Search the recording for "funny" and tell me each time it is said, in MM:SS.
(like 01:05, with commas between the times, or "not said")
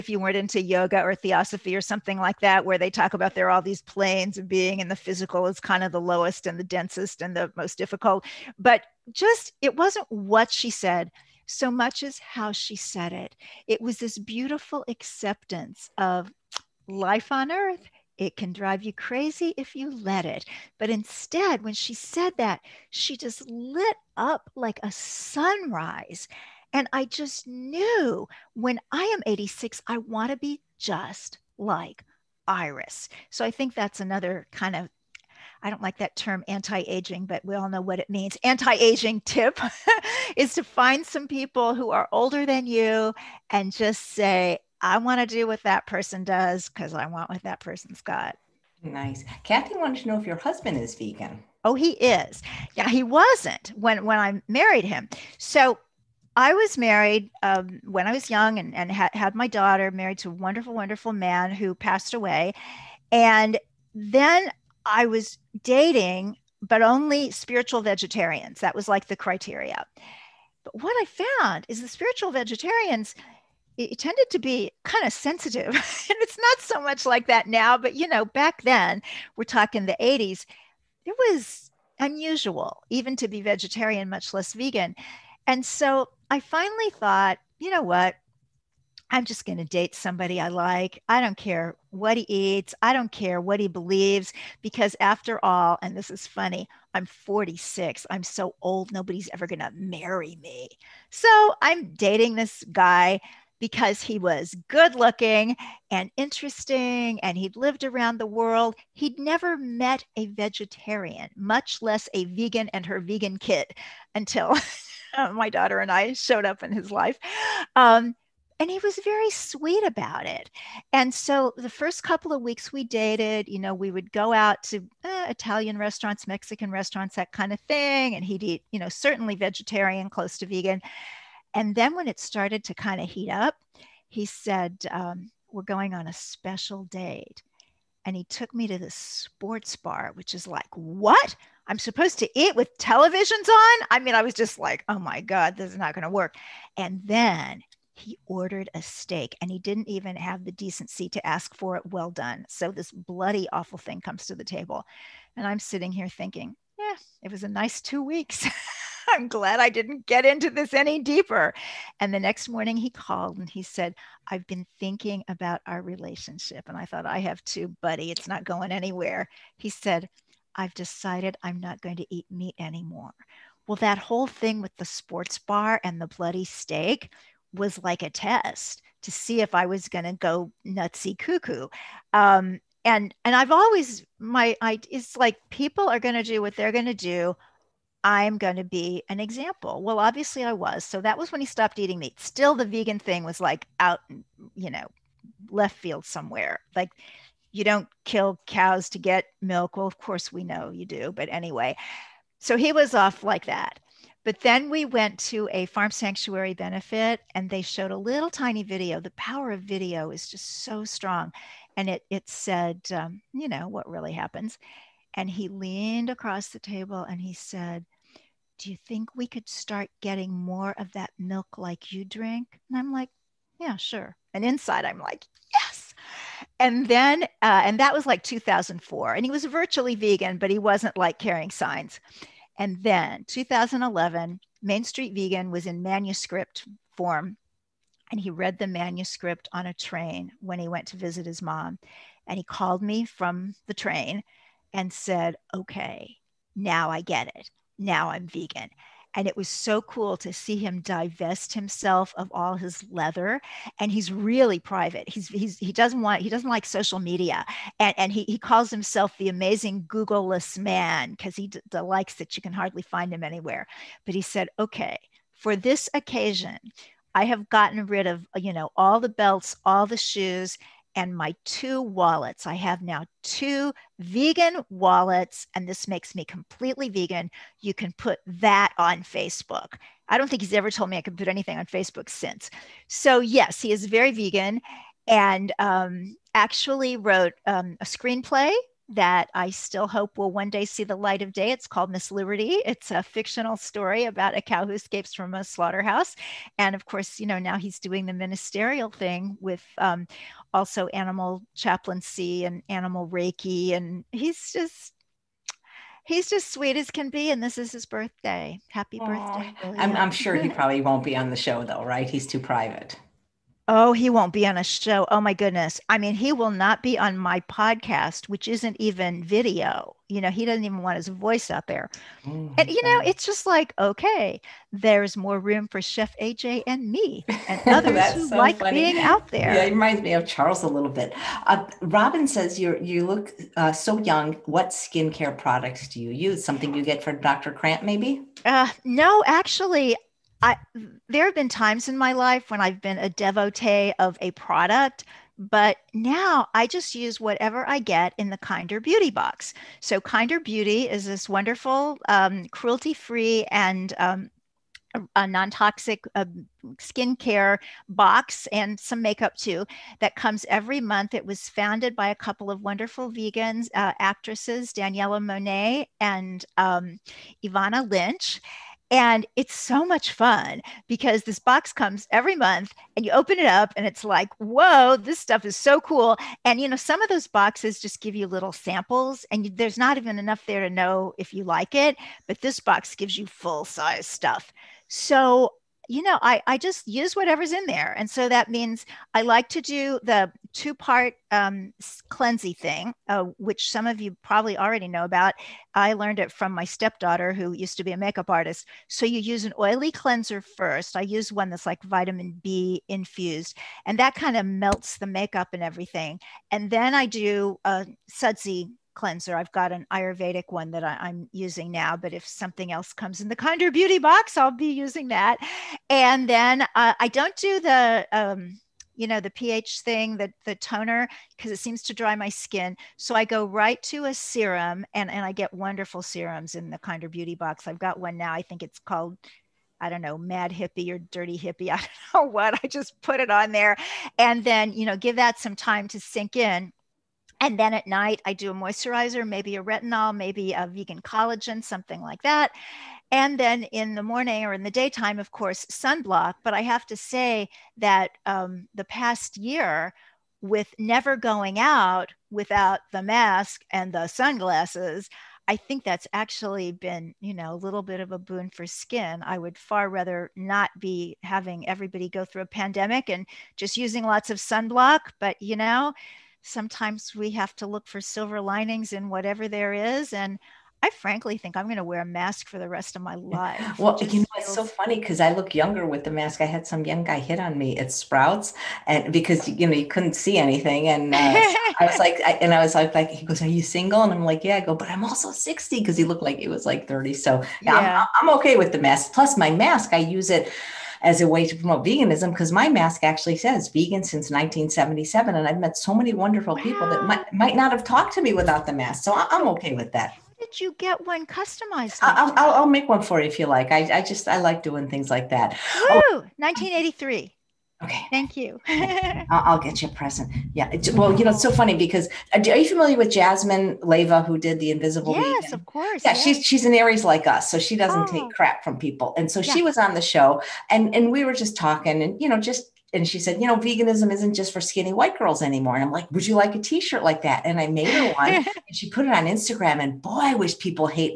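01:36, 05:28, 07:54, 08:31.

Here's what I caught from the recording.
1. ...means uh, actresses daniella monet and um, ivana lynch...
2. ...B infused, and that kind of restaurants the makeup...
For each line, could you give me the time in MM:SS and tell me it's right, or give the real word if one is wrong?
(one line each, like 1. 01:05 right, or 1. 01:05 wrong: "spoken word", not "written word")
1. 06:03 wrong: "vegans", not "means"
2. 06:42 wrong: "melts", not "restaurants".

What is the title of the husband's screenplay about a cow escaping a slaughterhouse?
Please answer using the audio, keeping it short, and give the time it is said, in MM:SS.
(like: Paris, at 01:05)
Miss Liberty, at 04:51.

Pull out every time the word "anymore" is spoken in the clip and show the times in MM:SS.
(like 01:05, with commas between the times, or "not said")
02:52, 08:45.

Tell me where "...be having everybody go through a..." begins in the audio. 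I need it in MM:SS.
07:40.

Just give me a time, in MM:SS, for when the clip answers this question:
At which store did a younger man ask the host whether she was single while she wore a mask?
07:57.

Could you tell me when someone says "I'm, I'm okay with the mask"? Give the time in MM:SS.
08:08.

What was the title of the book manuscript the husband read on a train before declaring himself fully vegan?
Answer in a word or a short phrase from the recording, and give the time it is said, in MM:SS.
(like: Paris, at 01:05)
Main Street Vegan, at 03:54.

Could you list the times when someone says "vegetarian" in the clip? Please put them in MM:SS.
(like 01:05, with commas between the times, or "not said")
01:07, 01:12, 01:23, 01:50, 02:09.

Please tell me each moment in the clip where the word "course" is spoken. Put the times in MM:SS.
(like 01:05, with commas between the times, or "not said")
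03:19, 04:56, 07:25, 08:35.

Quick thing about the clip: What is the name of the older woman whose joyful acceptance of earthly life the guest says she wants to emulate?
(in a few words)
Iris.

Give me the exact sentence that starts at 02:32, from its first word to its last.
So this bloody, awful thing comes to the table.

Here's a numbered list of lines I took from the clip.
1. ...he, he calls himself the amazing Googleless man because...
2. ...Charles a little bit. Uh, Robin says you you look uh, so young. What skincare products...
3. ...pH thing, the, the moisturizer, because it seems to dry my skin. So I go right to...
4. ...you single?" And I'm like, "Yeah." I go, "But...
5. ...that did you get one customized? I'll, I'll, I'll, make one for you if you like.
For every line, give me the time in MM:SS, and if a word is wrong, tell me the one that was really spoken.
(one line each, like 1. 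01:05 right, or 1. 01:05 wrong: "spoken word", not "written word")
1. 04:18 right
2. 05:30 right
3. 06:59 wrong: "toner", not "moisturizer"
4. 08:03 right
5. 08:19 right.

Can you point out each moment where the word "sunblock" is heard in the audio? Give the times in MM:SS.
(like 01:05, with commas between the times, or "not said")
07:25, 07:44.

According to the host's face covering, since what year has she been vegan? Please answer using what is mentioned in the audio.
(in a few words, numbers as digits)
1977.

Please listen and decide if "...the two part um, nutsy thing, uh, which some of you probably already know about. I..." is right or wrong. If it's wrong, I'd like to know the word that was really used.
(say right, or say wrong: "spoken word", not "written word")
wrong: "cleansy", not "nutsy".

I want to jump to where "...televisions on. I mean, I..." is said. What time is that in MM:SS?
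02:22.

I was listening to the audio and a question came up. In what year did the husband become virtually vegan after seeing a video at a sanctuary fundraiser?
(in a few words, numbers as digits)
2004.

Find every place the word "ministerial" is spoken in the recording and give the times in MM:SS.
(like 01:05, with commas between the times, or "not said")
04:58.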